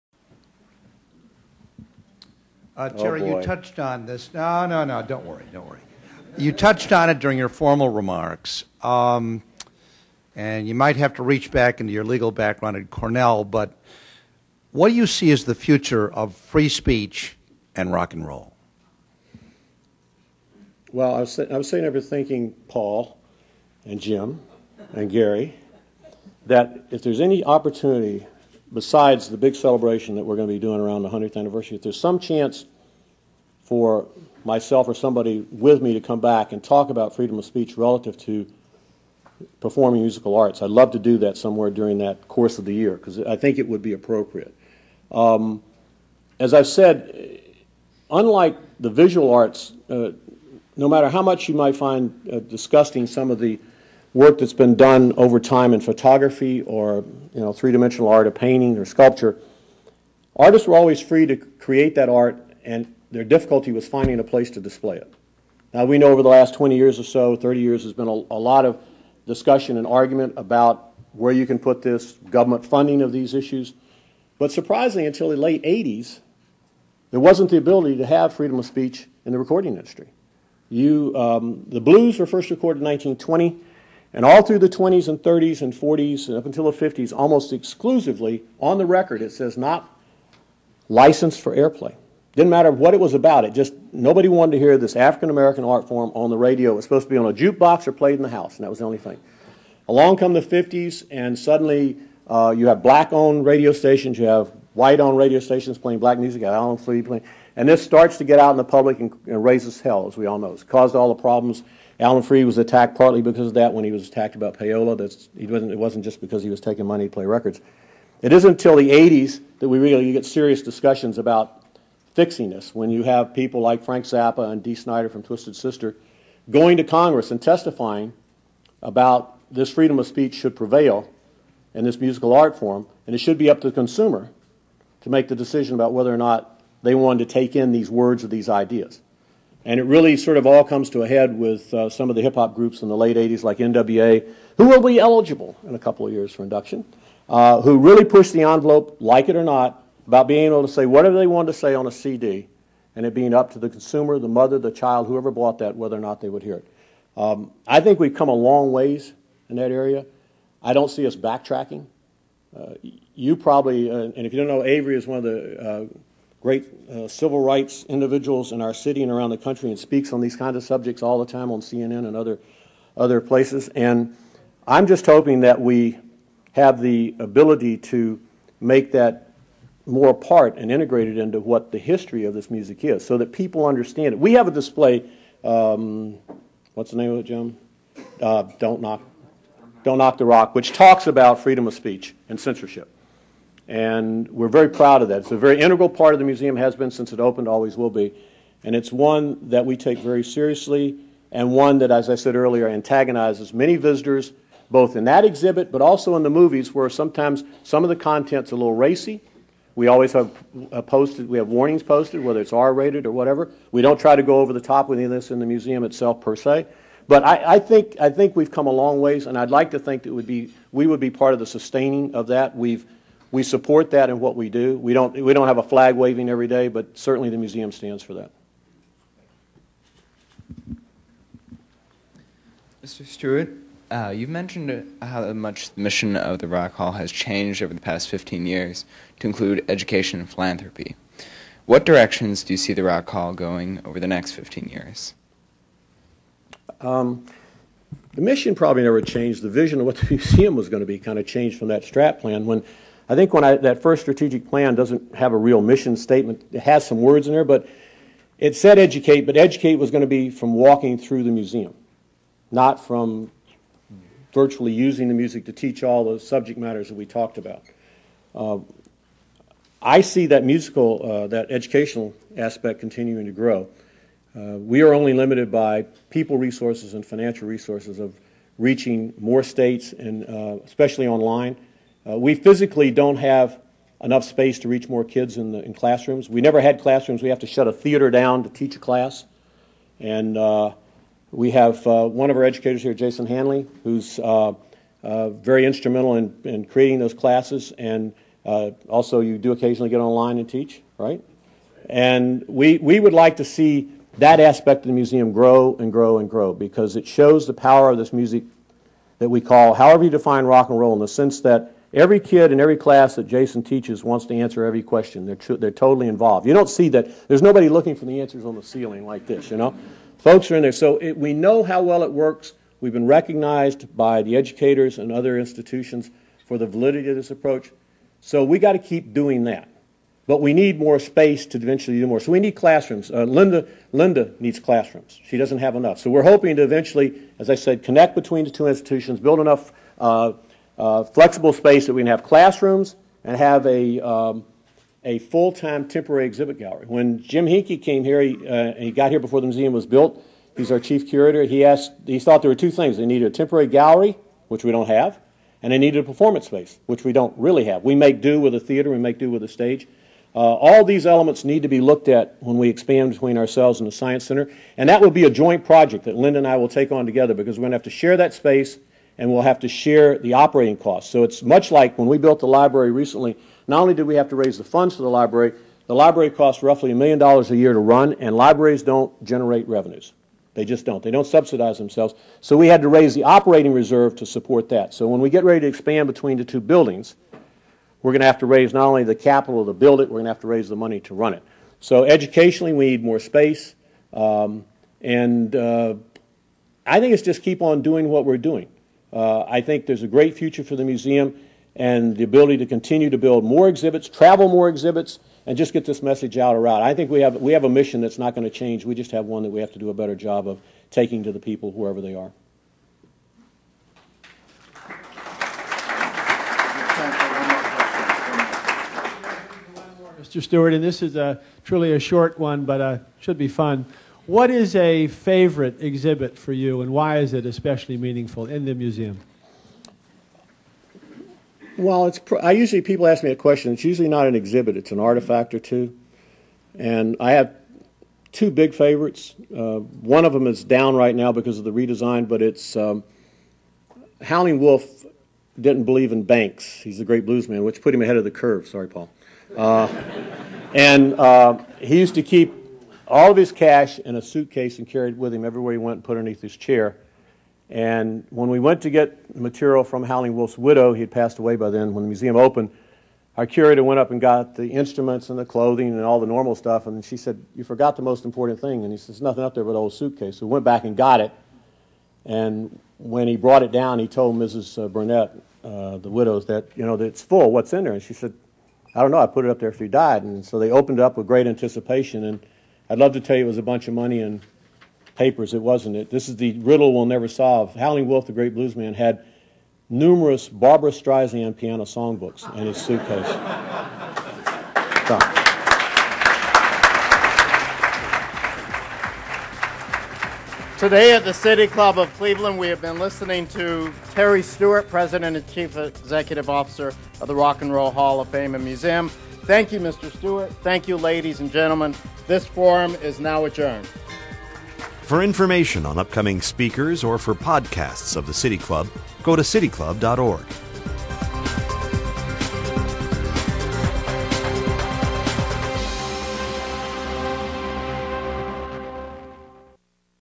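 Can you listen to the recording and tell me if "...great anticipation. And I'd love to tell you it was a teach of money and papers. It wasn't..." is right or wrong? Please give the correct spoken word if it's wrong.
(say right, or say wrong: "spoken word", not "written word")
wrong: "bunch", not "teach".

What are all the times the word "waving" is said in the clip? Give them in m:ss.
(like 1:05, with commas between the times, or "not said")
3:45.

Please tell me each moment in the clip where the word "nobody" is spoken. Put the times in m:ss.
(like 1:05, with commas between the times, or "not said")
1:33, 5:17.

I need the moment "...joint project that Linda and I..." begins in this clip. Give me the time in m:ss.
6:05.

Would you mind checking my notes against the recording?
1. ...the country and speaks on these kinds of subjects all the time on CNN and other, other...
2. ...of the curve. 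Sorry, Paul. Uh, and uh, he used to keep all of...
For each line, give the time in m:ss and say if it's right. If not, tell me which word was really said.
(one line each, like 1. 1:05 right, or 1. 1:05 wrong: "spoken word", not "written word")
1. 2:49 right
2. 7:28 right.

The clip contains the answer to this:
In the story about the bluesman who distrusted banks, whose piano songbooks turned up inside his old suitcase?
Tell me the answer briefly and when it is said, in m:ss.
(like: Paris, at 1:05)
Barbra Streisand, at 8:10.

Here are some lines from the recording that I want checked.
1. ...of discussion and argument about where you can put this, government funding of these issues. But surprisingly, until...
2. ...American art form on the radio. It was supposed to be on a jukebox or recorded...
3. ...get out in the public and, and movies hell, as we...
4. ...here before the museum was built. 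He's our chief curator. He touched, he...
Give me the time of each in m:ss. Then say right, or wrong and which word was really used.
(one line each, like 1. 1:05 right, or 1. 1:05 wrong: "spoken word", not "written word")
1. 1:08 right
2. 1:35 wrong: "played", not "recorded"
3. 1:48 wrong: "raises", not "movies"
4. 5:49 wrong: "asked", not "touched".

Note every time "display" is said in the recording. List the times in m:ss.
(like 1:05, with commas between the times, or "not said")
1:04, 3:04.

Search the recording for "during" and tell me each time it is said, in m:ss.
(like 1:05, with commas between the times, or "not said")
0:07, 0:41.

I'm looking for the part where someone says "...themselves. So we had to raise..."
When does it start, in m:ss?
6:21.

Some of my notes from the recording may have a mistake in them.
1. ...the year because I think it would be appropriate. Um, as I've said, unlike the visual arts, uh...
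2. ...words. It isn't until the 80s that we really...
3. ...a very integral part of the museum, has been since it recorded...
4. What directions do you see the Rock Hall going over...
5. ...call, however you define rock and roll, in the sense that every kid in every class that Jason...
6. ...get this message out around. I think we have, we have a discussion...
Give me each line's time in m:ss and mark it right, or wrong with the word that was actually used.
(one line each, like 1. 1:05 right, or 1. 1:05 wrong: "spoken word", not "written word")
1. 0:42 right
2. 1:57 wrong: "records", not "words"
3. 3:15 wrong: "opened", not "recorded"
4. 4:01 right
5. 5:09 right
6. 6:45 wrong: "mission", not "discussion".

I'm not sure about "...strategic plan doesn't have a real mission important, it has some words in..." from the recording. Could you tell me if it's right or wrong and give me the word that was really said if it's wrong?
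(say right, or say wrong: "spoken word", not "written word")
wrong: "statement", not "important".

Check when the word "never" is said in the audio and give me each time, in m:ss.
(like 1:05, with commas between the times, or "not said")
4:08, 4:46, 8:07.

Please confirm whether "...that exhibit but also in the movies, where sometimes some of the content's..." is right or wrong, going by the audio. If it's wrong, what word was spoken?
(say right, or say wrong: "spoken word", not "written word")
right.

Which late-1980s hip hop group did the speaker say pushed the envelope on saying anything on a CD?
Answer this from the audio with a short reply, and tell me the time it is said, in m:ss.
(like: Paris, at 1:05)
NWA, at 2:23.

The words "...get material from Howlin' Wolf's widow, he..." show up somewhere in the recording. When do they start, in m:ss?
7:38.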